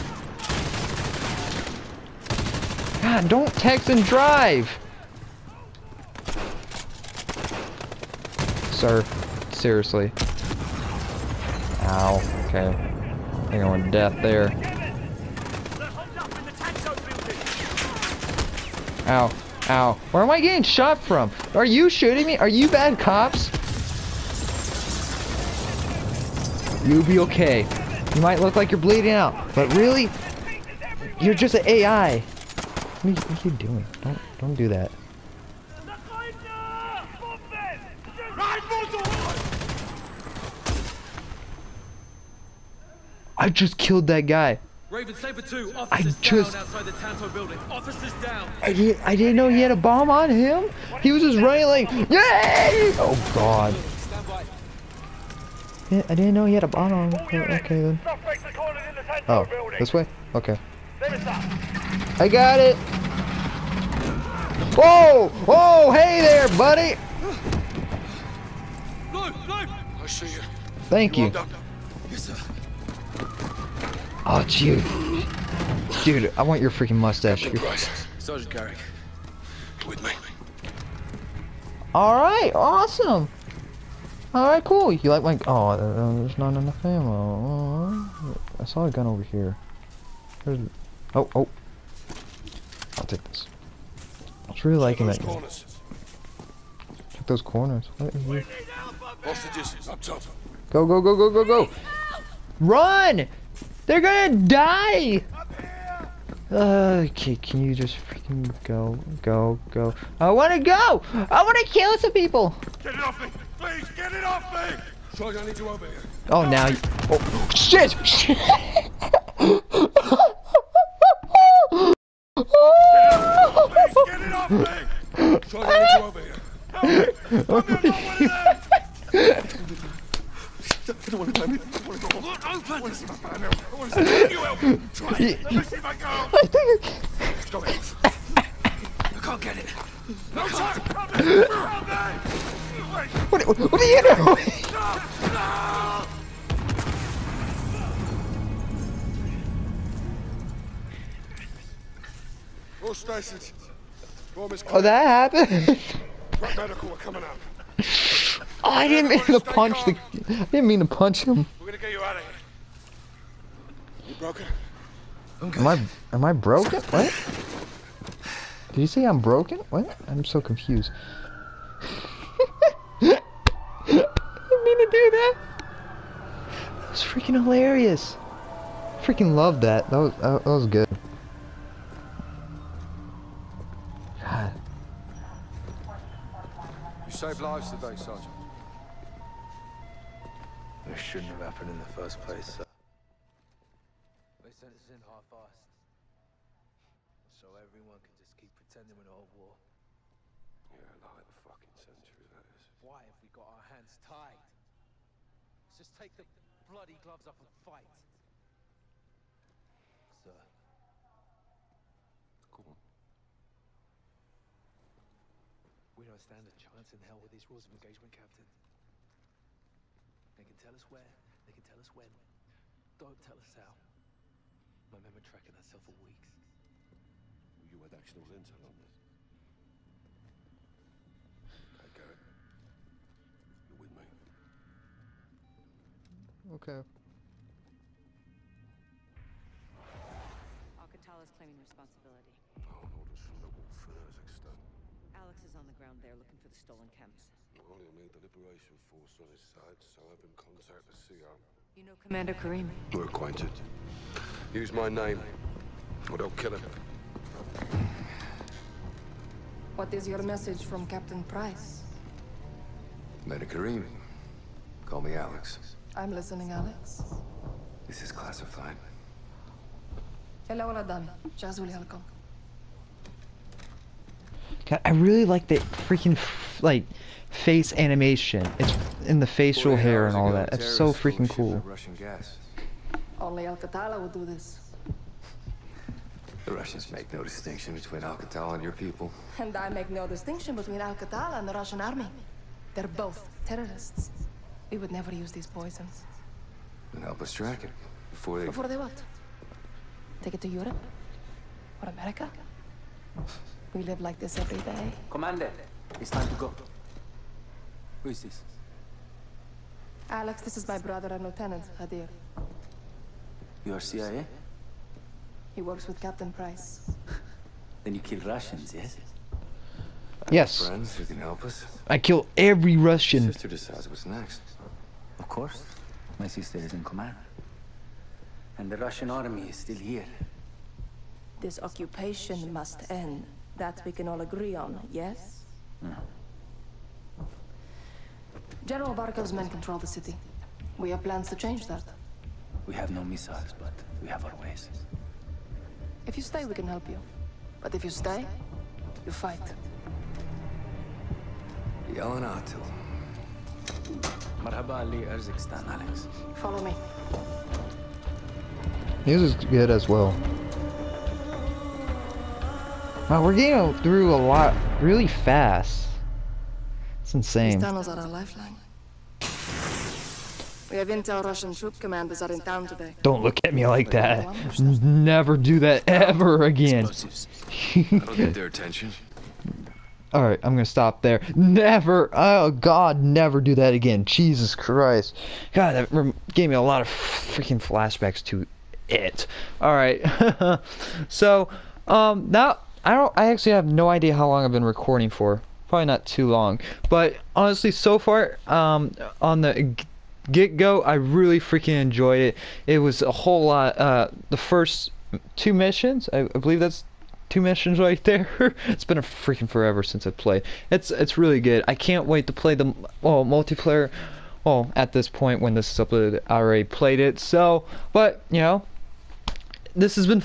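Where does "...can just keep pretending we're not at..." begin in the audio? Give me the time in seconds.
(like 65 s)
198 s.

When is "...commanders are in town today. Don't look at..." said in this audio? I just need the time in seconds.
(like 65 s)
371 s.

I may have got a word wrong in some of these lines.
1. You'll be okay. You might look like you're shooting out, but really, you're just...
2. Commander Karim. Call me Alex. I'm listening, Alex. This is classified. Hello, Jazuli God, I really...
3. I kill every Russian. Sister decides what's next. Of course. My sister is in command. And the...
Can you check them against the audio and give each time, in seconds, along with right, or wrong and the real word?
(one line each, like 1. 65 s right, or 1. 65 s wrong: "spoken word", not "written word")
1. 26 s wrong: "bleeding", not "shooting"
2. 263 s right
3. 321 s right.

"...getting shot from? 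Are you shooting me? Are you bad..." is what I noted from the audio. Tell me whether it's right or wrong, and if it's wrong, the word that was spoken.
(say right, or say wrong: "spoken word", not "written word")
right.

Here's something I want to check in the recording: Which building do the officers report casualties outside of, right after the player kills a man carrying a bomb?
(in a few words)
Tanto building.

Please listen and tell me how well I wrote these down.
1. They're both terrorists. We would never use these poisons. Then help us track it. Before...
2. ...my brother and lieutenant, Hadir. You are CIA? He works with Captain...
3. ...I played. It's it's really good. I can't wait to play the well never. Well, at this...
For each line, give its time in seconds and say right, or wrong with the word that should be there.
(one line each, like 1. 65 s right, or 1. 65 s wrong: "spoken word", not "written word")
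1. 292 s right
2. 310 s right
3. 410 s wrong: "multiplayer", not "never".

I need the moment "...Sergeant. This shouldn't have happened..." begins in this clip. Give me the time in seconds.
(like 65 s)
187 s.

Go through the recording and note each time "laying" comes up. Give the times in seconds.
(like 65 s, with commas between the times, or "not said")
not said.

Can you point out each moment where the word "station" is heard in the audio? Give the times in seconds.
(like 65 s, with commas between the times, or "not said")
not said.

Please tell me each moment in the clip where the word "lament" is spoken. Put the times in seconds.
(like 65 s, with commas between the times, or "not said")
not said.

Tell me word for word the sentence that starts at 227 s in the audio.
You had actual intel on this.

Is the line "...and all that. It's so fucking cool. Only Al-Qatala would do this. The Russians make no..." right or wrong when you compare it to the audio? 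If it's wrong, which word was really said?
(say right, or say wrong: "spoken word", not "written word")
wrong: "freaking", not "fucking".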